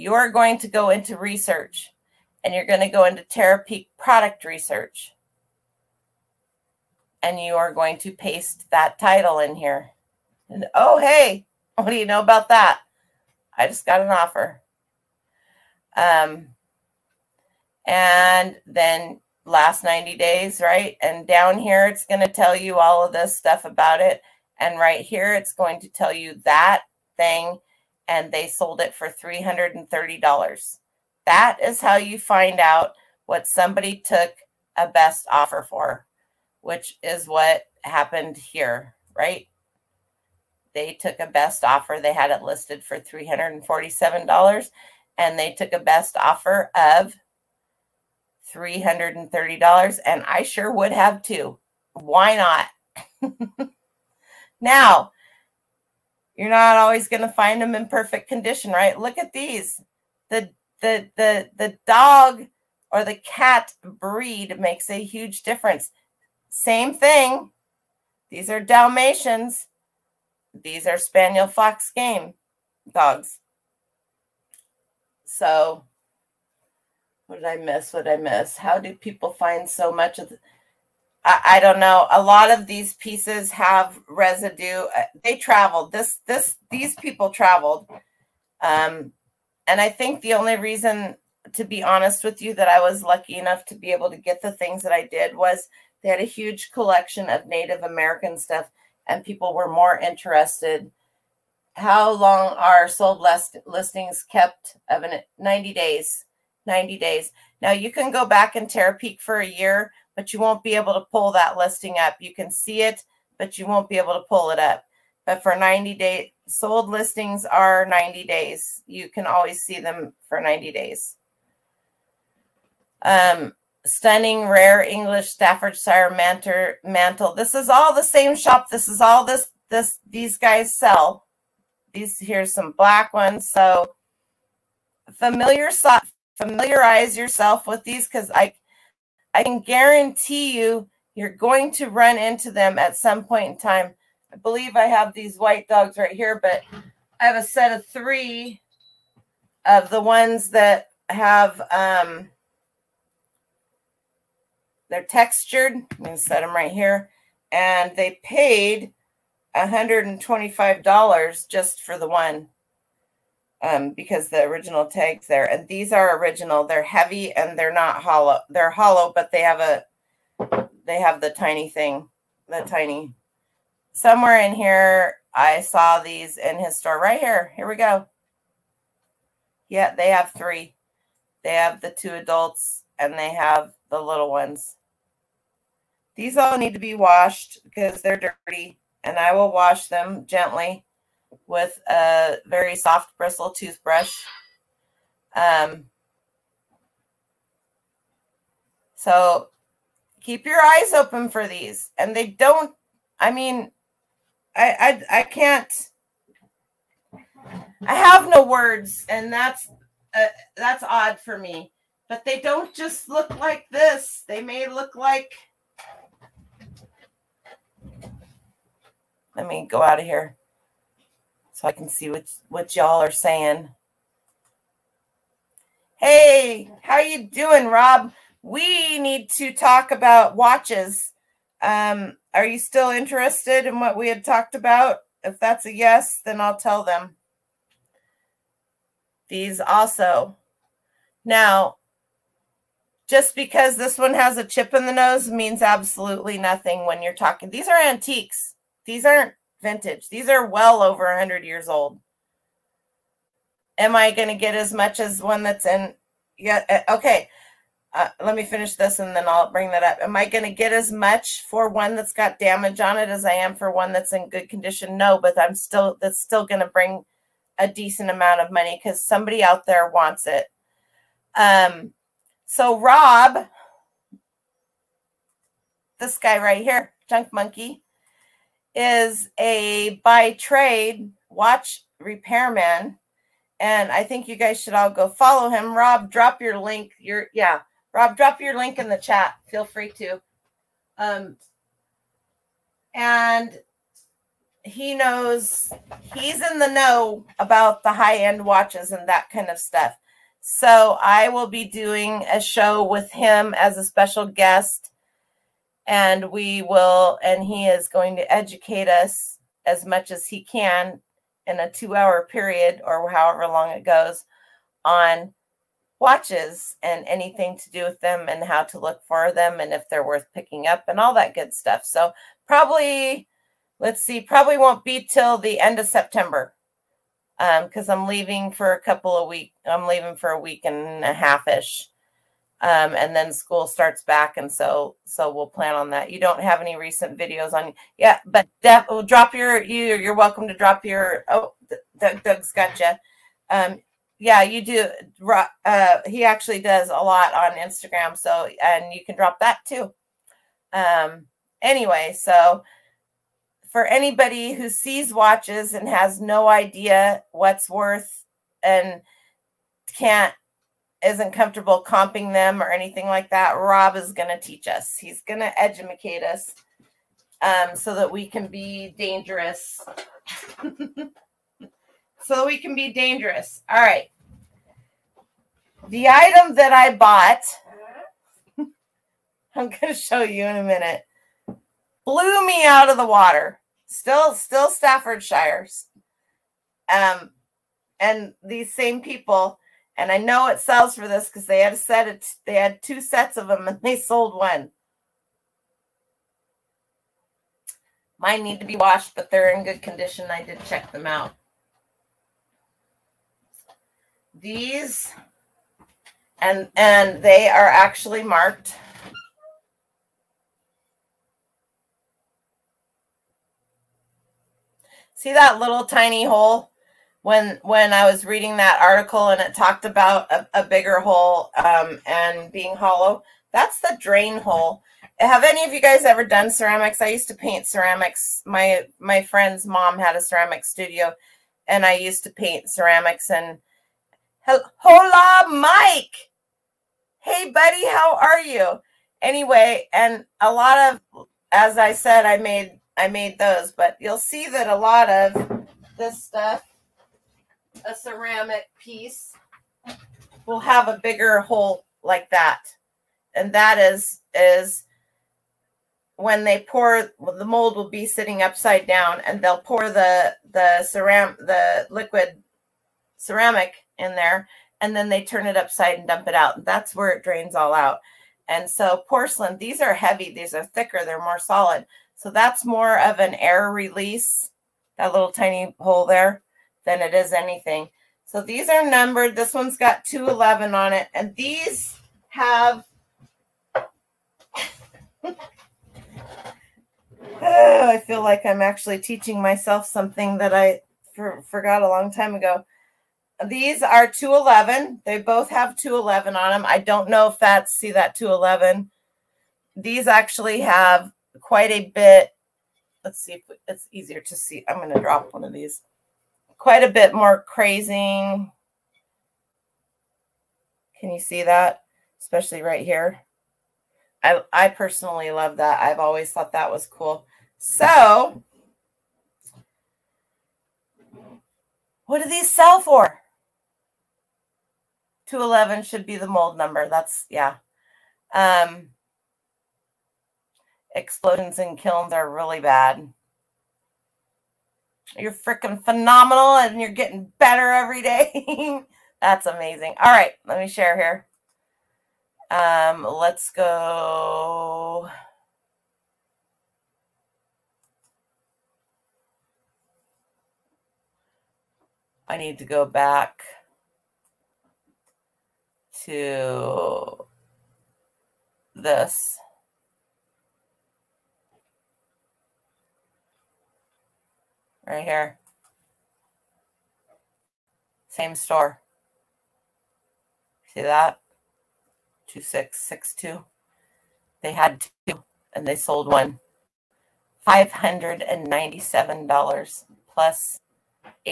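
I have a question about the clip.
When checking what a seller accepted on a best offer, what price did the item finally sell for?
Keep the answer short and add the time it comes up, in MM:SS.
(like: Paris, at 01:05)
$330, at 00:28.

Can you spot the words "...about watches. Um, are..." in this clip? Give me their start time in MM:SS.
03:49.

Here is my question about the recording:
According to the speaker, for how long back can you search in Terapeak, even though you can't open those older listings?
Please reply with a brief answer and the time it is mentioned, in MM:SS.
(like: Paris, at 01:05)
a year, at 01:47.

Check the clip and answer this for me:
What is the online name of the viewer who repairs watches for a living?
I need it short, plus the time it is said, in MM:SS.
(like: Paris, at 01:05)
Junk Monkey, at 04:37.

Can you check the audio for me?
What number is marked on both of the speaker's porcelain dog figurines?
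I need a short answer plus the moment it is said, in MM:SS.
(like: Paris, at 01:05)
211, at 07:59.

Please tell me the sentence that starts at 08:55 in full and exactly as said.
You're freaking phenomenal and you're getting better every day.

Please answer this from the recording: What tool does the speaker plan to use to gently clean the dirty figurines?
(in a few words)
soft bristle toothbrush.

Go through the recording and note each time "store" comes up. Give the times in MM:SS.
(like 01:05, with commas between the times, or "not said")
02:56, 09:28.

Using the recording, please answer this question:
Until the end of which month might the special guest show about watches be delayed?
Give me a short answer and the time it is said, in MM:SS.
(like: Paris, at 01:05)
September, at 05:25.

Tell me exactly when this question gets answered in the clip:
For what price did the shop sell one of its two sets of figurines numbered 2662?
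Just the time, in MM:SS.
09:37.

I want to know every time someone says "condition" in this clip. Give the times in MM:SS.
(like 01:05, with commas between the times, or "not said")
00:58, 04:24, 06:39.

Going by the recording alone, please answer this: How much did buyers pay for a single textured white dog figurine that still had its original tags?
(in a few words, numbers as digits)
$125.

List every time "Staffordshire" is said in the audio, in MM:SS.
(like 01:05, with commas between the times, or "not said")
02:05, 06:24.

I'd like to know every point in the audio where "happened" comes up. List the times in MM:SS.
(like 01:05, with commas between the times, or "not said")
00:37.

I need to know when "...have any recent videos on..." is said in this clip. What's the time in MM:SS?
05:36.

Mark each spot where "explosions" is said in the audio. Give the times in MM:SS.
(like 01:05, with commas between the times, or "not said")
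08:50.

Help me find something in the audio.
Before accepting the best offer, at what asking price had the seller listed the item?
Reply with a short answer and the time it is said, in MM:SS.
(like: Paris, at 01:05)
$347, at 00:42.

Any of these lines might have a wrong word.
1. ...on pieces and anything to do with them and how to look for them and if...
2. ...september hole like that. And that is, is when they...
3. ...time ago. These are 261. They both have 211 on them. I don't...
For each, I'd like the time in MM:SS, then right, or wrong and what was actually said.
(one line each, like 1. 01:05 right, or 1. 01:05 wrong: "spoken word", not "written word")
1. 05:14 wrong: "watches", not "pieces"
2. 07:31 wrong: "bigger", not "september"
3. 08:12 wrong: "211", not "261".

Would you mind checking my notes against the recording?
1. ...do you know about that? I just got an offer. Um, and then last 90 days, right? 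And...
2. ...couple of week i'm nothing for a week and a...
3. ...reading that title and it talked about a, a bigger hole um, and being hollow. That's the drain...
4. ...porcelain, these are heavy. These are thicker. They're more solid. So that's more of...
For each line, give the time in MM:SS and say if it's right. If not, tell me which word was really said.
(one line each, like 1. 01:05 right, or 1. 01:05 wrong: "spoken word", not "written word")
1. 00:11 right
2. 05:28 wrong: "leaving", not "nothing"
3. 06:58 wrong: "article", not "title"
4. 07:49 right.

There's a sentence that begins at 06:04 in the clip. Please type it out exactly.
He's going to educate us um, so that we can be dangerous.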